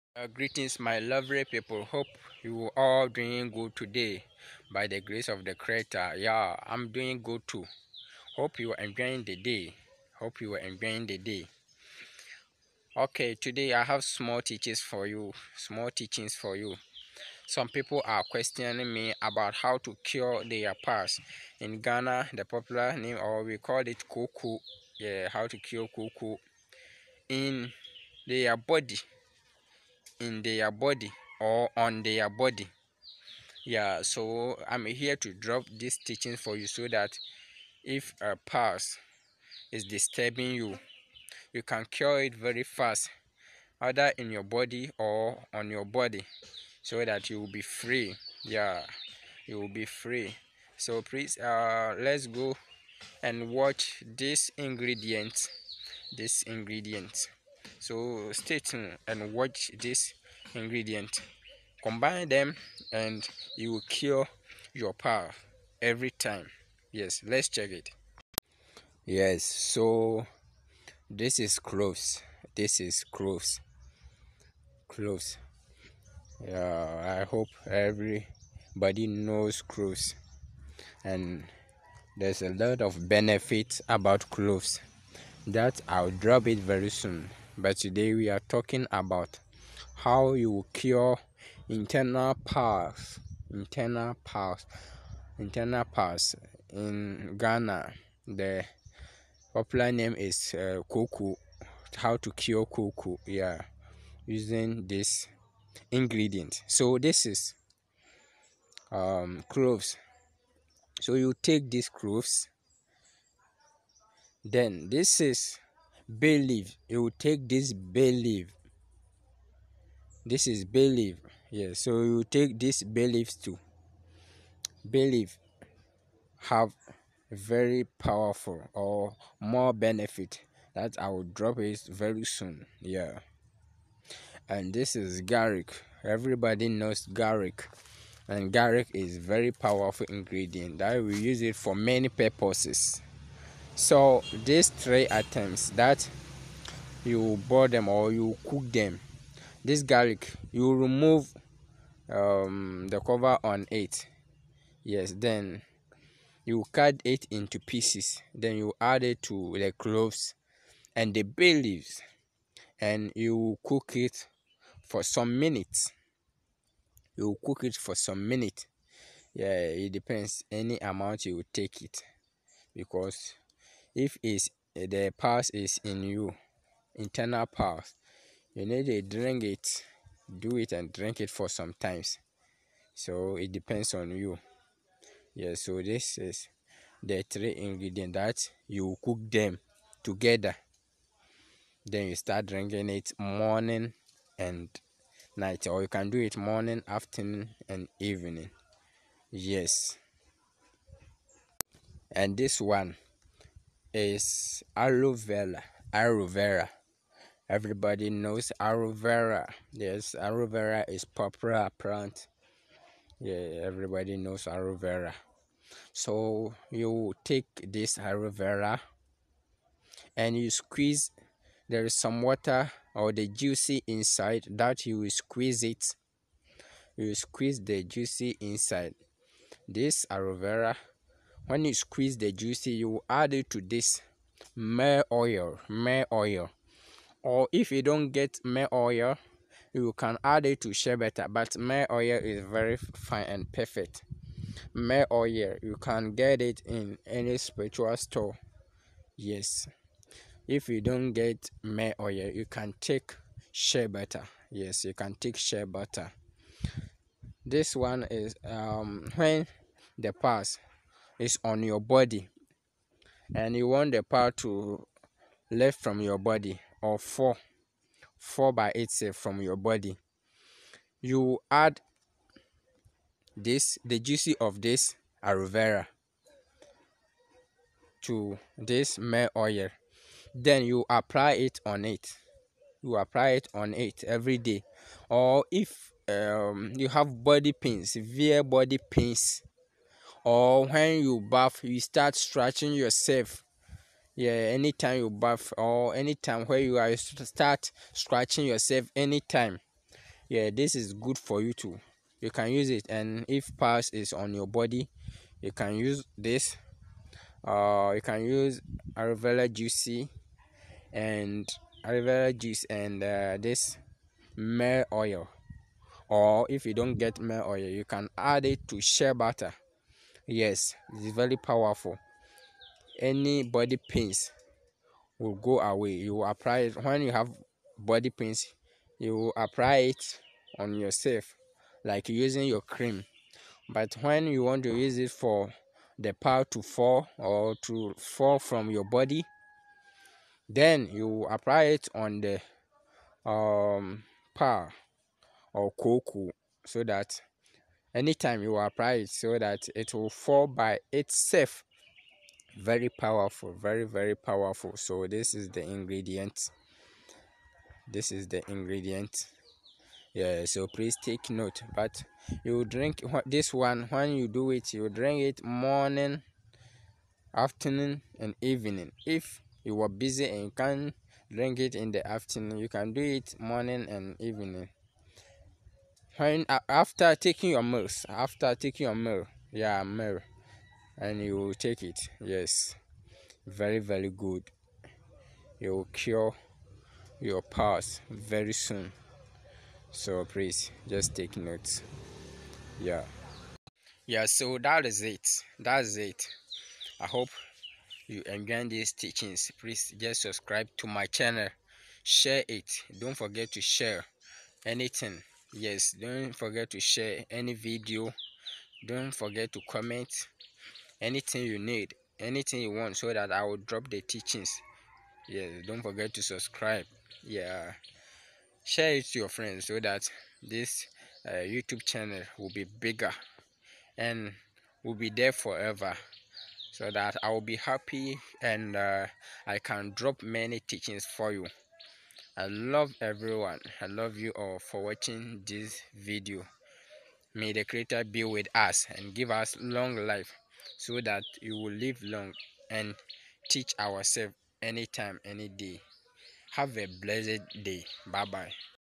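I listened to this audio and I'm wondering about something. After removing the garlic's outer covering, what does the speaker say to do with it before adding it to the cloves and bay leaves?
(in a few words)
cut it into pieces.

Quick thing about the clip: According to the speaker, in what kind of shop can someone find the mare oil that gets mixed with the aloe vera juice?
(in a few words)
spiritual store.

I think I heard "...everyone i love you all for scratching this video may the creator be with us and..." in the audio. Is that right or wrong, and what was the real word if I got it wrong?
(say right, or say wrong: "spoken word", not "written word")
wrong: "watching", not "scratching".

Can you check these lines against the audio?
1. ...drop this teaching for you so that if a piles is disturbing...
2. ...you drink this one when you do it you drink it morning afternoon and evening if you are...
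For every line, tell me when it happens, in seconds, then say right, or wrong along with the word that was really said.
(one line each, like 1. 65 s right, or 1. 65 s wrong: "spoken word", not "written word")
1. 35 s right
2. 362 s right.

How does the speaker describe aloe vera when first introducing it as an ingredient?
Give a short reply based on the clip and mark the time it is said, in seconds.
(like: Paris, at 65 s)
popular plant, at 211 s.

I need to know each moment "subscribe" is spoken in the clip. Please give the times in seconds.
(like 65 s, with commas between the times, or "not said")
400 s, 416 s.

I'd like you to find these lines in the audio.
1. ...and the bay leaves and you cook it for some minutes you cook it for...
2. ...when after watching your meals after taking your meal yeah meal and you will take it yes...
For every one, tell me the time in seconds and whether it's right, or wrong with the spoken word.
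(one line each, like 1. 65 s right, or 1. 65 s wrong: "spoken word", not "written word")
1. 160 s right
2. 376 s wrong: "taking", not "watching".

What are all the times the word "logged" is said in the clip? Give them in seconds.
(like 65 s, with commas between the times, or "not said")
not said.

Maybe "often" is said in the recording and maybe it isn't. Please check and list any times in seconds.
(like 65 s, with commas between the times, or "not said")
not said.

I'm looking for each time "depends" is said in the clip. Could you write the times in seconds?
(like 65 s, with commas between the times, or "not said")
169 s, 183 s.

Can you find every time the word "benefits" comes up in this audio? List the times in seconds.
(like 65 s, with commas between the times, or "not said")
83 s, 129 s.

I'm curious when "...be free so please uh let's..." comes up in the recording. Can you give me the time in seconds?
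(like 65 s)
49 s.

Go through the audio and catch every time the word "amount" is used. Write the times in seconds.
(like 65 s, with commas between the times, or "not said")
170 s.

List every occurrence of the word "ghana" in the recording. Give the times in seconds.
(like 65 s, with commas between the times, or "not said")
21 s, 97 s.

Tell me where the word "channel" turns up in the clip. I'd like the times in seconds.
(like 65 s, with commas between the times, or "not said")
401 s, 421 s.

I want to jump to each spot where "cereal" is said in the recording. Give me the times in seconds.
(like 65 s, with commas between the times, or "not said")
not said.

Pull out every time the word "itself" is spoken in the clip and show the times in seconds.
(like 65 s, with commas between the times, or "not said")
268 s, 350 s.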